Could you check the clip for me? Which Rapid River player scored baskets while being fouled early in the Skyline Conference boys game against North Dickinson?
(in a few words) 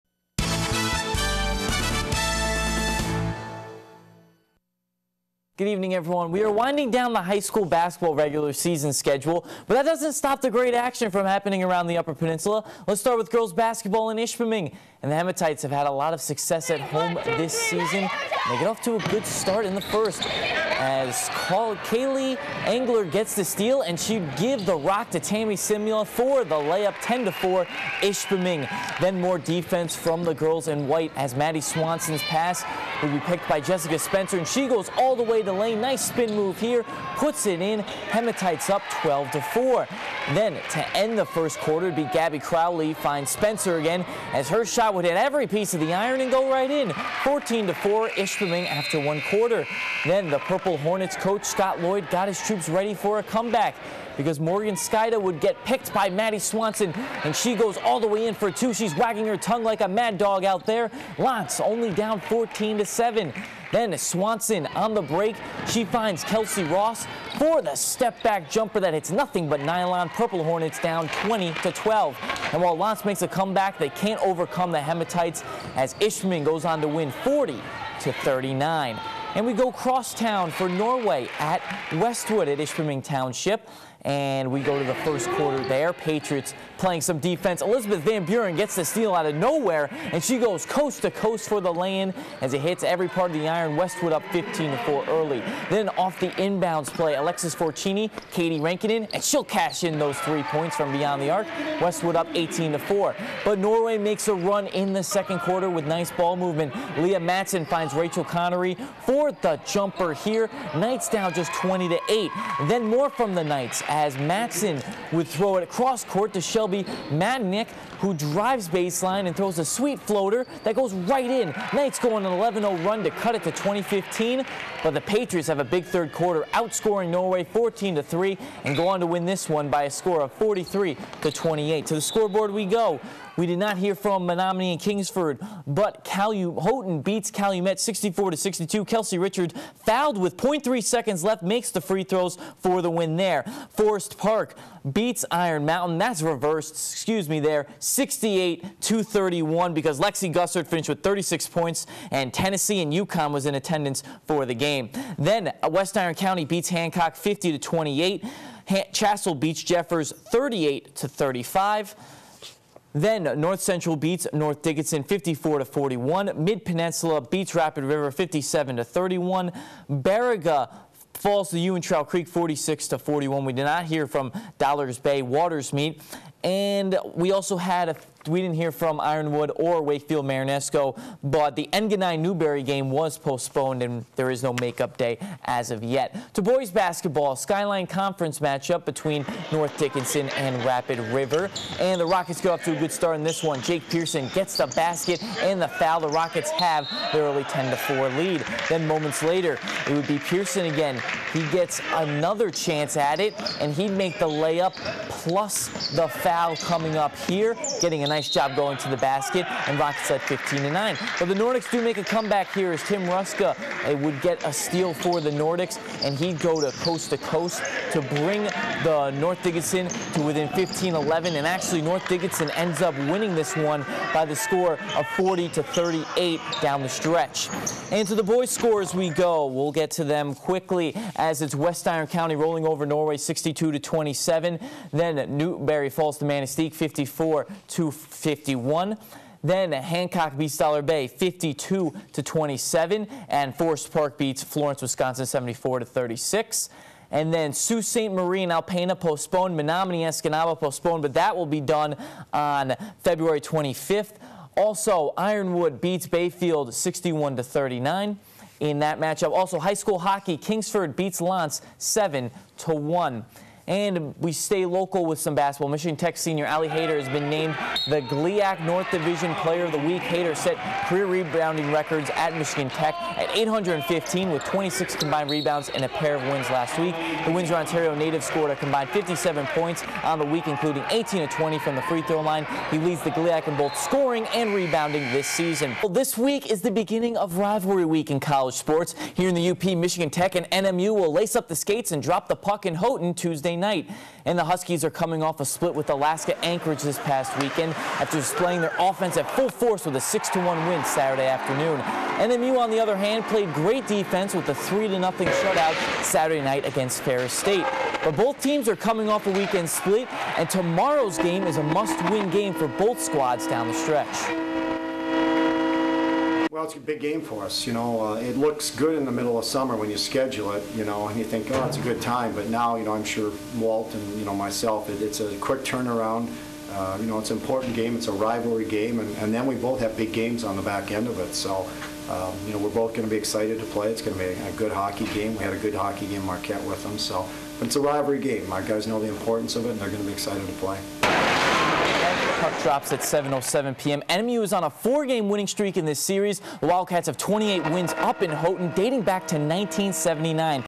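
Jake Pearson.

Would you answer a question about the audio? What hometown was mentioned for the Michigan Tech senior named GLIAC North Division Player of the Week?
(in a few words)
Windsor, Ontario.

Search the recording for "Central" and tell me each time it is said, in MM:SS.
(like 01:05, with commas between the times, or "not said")
02:43.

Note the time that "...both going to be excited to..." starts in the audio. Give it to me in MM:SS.
05:32.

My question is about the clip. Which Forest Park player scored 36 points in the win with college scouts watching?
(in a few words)
Lexi Gussard.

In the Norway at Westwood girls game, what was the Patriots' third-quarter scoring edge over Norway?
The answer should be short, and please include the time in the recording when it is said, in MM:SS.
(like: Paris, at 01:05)
14-3, at 02:07.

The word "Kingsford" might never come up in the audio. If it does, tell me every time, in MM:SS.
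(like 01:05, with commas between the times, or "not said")
02:14, 04:20.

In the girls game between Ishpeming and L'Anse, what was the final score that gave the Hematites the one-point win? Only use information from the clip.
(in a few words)
40 to 39.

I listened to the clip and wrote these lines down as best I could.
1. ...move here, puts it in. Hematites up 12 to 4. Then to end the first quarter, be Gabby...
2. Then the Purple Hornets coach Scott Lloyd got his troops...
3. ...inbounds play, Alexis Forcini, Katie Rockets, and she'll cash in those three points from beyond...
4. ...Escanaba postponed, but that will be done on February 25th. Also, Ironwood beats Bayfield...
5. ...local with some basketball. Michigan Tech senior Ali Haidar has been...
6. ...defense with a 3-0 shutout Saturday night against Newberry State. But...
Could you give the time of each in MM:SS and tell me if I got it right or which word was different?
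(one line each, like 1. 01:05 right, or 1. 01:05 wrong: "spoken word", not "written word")
1. 00:36 right
2. 00:50 right
3. 01:36 wrong: "Rankinen", not "Rockets"
4. 04:10 right
5. 04:24 right
6. 05:03 wrong: "Ferris", not "Newberry".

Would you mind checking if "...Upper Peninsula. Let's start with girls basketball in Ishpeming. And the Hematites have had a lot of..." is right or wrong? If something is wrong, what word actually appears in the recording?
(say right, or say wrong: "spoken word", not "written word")
right.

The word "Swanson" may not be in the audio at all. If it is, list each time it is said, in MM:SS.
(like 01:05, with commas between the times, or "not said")
00:31, 00:56, 01:03.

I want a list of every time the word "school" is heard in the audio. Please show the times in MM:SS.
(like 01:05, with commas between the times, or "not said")
00:07, 04:19.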